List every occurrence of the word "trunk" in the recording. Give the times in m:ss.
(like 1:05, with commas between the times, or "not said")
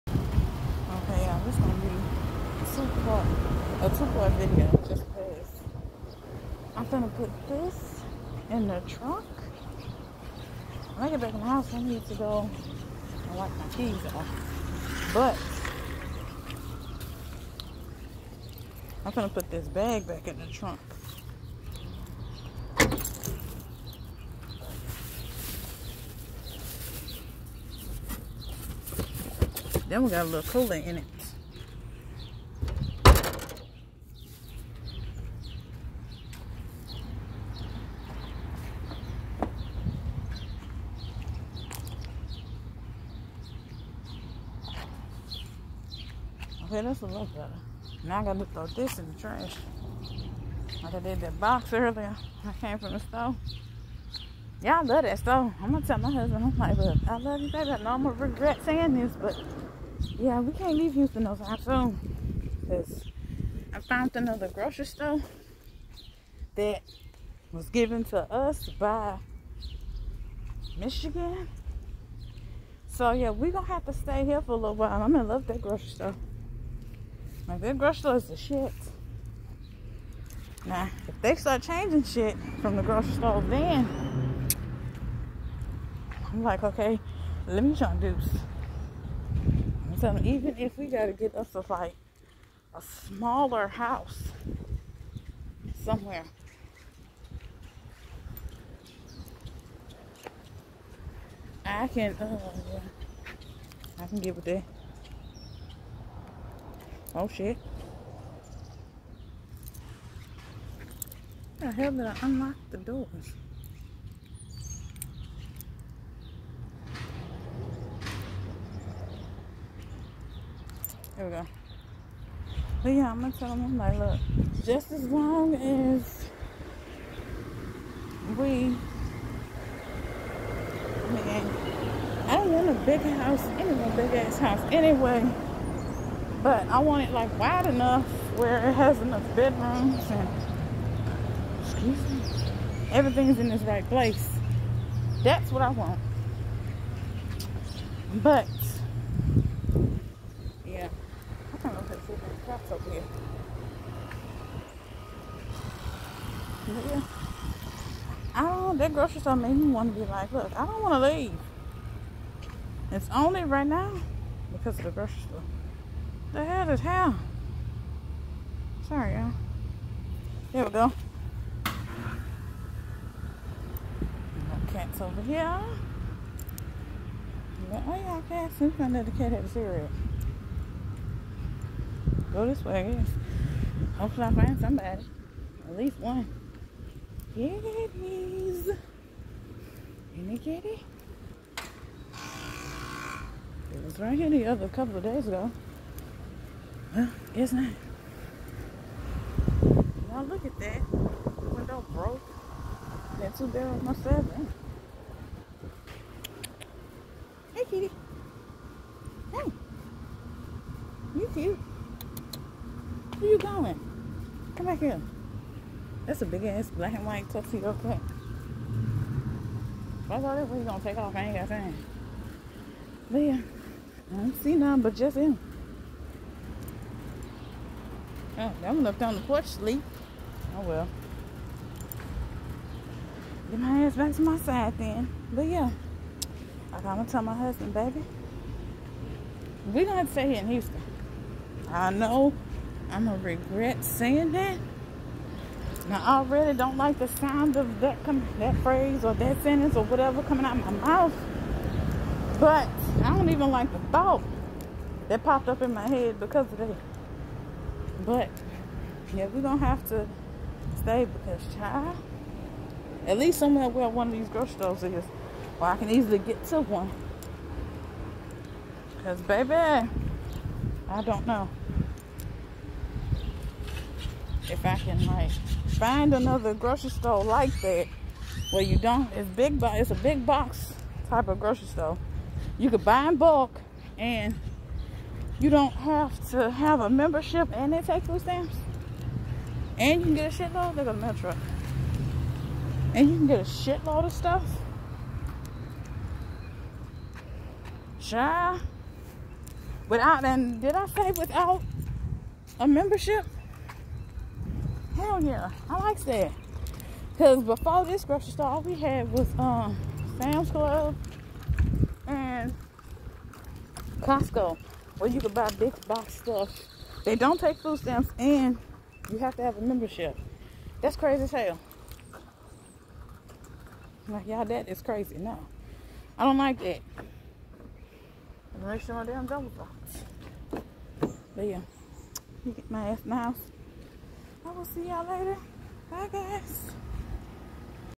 0:08, 0:20.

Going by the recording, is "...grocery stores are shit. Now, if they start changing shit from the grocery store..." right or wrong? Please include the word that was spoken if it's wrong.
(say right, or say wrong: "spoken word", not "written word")
right.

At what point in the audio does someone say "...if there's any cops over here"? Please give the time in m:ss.
2:31.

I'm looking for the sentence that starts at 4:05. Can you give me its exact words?
Now I really don't like the sound of that that phrase or that sentence or whatever coming out of my mouth.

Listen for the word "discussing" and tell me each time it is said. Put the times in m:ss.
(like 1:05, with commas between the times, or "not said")
not said.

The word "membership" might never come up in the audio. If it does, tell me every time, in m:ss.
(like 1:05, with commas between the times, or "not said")
4:46, 5:02, 5:19.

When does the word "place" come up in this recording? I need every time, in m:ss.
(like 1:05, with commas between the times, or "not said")
2:23.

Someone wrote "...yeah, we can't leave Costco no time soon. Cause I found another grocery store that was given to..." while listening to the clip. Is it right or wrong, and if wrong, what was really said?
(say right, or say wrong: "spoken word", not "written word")
wrong: "Houston", not "Costco".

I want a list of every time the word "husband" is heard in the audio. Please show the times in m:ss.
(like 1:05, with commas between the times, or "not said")
0:56, 3:57.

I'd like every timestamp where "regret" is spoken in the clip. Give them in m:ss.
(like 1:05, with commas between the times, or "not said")
0:58, 4:03.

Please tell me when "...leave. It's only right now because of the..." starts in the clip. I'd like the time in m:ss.
2:41.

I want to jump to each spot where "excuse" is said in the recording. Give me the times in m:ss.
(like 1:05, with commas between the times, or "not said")
2:21.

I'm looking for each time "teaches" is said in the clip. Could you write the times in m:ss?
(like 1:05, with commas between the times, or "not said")
not said.